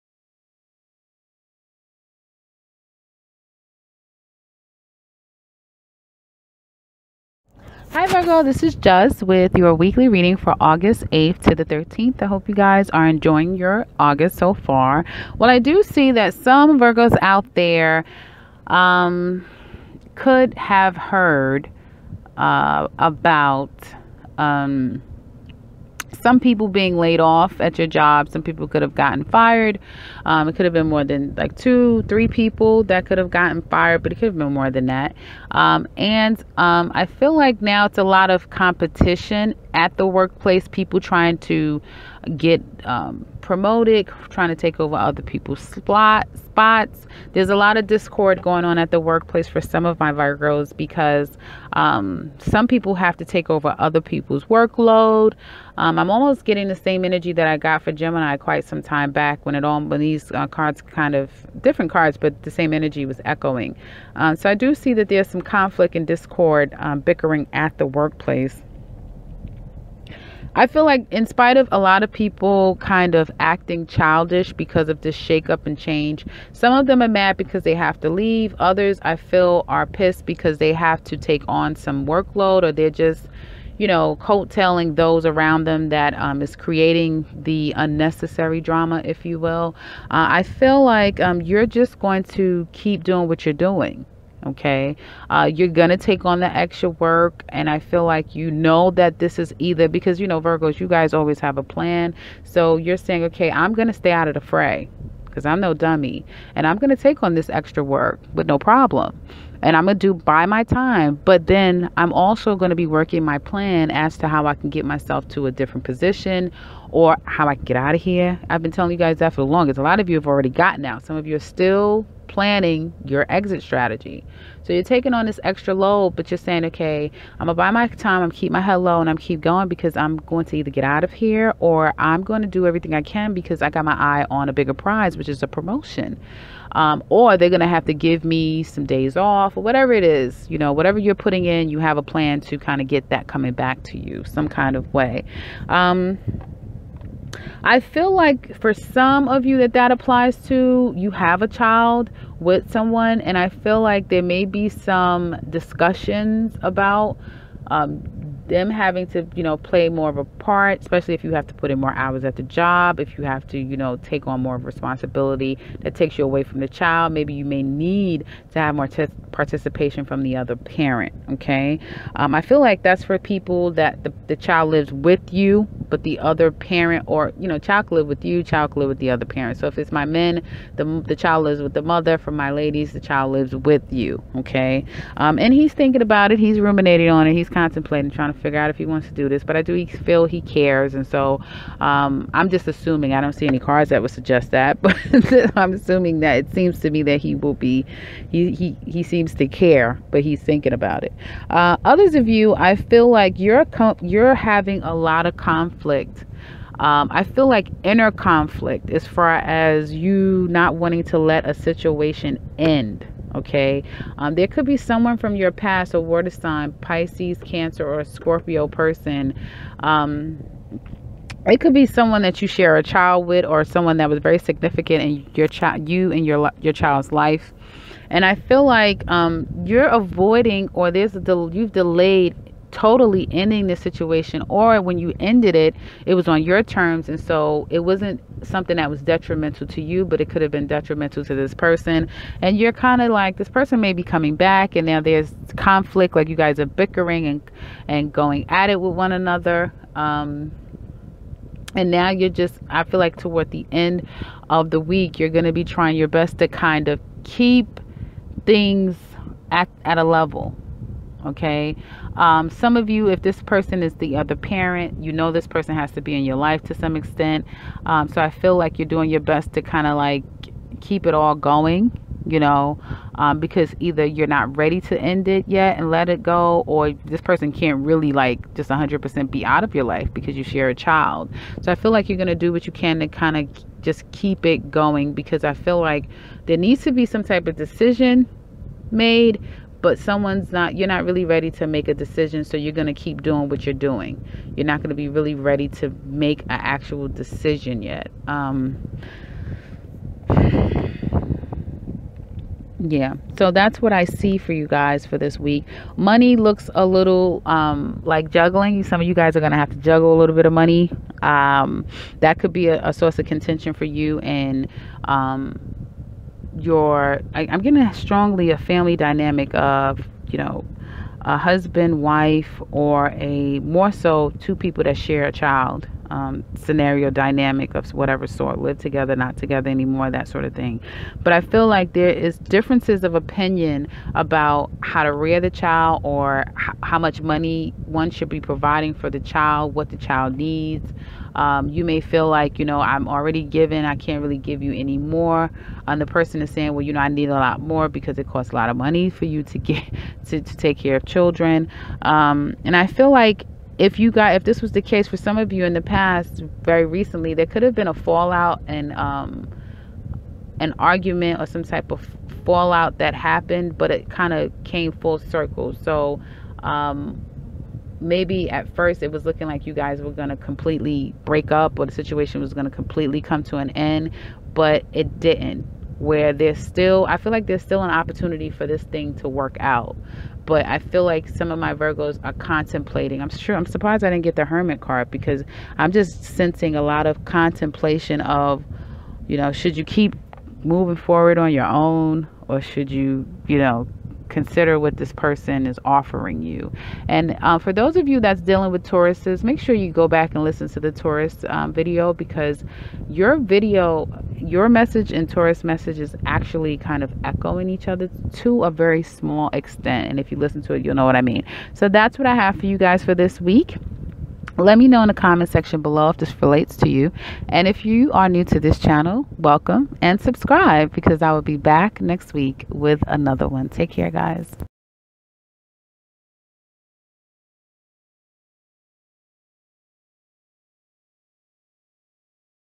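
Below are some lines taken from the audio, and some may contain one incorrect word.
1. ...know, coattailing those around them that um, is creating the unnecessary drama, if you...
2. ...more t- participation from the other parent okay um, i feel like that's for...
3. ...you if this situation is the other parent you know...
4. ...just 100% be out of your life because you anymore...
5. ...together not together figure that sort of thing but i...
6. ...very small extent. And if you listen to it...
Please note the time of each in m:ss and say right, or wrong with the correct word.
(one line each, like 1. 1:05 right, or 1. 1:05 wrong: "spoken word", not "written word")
1. 1:23 right
2. 2:48 right
3. 4:22 wrong: "person", not "situation"
4. 4:38 wrong: "share", not "anymore"
5. 5:28 wrong: "anymore", not "figure"
6. 6:48 right.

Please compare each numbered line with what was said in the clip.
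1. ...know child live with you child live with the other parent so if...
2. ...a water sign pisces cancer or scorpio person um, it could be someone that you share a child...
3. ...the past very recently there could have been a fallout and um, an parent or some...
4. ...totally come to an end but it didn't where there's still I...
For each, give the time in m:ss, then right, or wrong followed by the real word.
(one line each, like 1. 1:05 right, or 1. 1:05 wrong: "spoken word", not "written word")
1. 2:57 right
2. 3:35 right
3. 5:55 wrong: "argument", not "parent"
4. 6:12 wrong: "completely", not "totally".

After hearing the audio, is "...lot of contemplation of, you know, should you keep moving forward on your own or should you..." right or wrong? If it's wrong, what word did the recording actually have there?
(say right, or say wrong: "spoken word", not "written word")
right.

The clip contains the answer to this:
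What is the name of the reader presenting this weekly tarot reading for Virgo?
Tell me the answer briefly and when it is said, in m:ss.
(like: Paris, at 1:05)
Juss, at 0:08.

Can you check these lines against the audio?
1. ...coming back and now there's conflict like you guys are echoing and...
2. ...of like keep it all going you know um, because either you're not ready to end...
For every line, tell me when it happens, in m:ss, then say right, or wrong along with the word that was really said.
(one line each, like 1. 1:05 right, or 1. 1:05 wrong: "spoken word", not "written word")
1. 4:04 wrong: "bickering", not "echoing"
2. 4:29 right.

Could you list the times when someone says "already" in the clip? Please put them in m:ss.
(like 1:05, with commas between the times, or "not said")
2:00, 5:43.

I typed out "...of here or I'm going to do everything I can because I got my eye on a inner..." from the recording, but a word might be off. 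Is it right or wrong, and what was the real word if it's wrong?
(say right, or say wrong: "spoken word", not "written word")
wrong: "bigger", not "inner".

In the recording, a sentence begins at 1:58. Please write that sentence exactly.
I've been telling you guys that for the longest.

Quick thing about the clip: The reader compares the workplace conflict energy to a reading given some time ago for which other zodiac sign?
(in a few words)
Gemini.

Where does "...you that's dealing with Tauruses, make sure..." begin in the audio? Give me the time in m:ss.
6:38.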